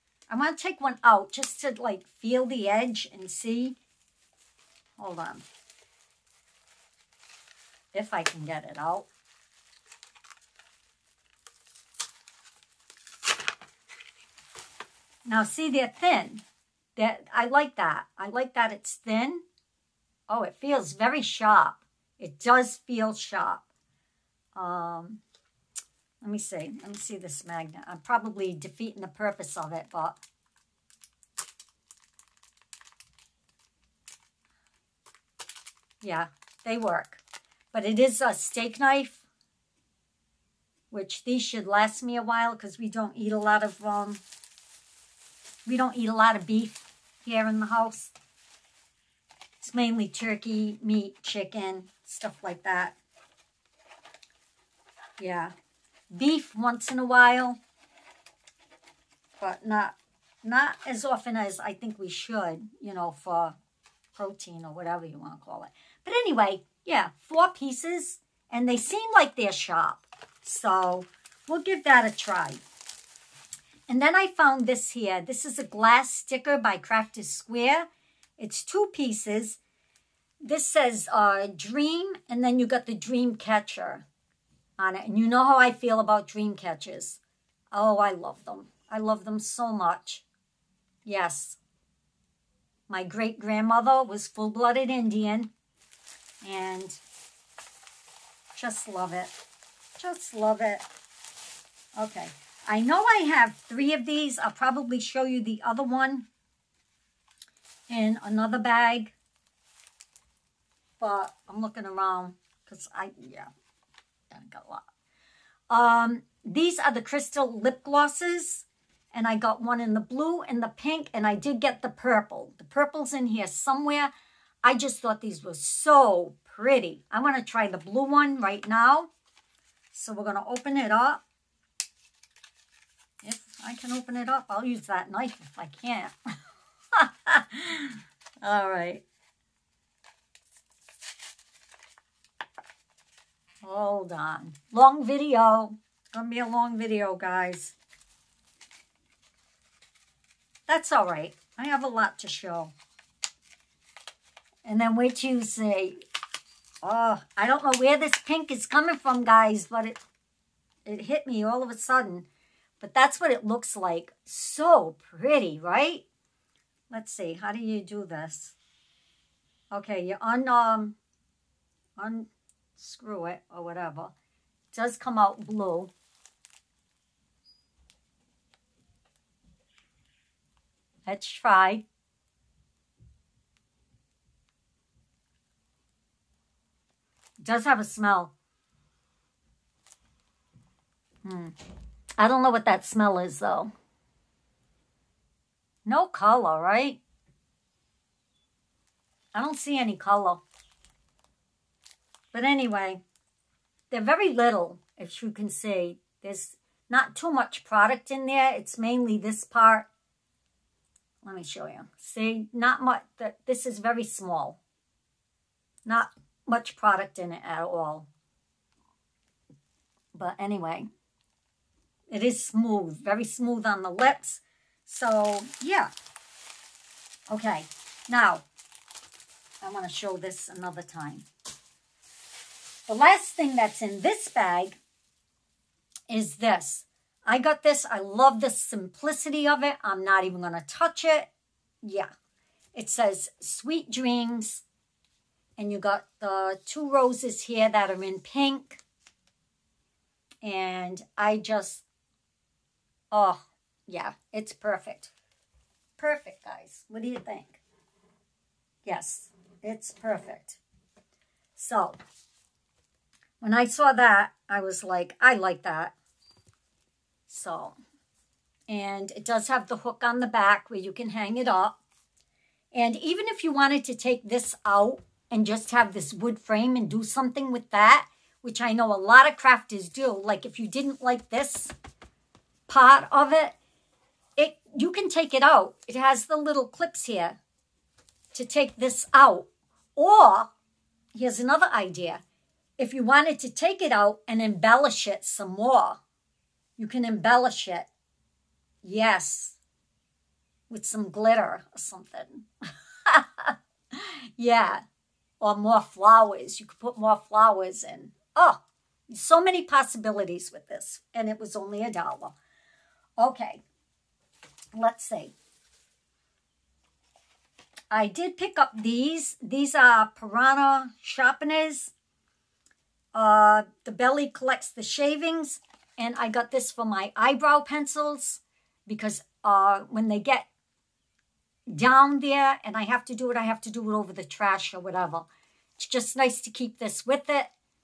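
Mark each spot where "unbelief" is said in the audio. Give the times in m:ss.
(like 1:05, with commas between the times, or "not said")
not said.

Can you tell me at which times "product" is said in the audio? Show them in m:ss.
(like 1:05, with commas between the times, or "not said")
3:27, 3:36.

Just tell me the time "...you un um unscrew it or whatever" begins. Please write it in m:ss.
2:50.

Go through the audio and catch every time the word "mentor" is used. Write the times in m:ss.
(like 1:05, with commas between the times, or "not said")
not said.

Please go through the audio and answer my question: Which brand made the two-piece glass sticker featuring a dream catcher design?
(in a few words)
Crafter's Square.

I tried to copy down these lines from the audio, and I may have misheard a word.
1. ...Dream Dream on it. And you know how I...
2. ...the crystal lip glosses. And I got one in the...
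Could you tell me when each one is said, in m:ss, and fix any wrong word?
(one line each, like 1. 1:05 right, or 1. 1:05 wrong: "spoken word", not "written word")
1. 1:22 wrong: "Catcher", not "Dream"
2. 1:56 right.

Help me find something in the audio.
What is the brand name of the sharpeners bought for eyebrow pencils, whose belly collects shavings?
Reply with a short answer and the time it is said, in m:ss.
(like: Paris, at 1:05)
Piranha, at 5:20.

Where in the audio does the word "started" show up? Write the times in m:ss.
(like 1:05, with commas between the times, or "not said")
not said.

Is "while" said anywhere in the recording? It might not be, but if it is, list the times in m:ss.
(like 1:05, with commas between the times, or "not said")
0:42, 0:57.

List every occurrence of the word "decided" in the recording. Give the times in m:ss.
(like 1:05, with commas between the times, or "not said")
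not said.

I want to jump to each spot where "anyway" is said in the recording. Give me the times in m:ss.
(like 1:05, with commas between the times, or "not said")
1:06, 3:22, 3:40.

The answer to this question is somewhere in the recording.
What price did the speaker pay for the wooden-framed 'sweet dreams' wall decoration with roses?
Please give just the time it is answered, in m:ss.
5:11.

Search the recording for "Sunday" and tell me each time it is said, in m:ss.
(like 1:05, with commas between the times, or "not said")
not said.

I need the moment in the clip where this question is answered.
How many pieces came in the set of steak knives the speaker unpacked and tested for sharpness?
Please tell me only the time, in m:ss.
1:07.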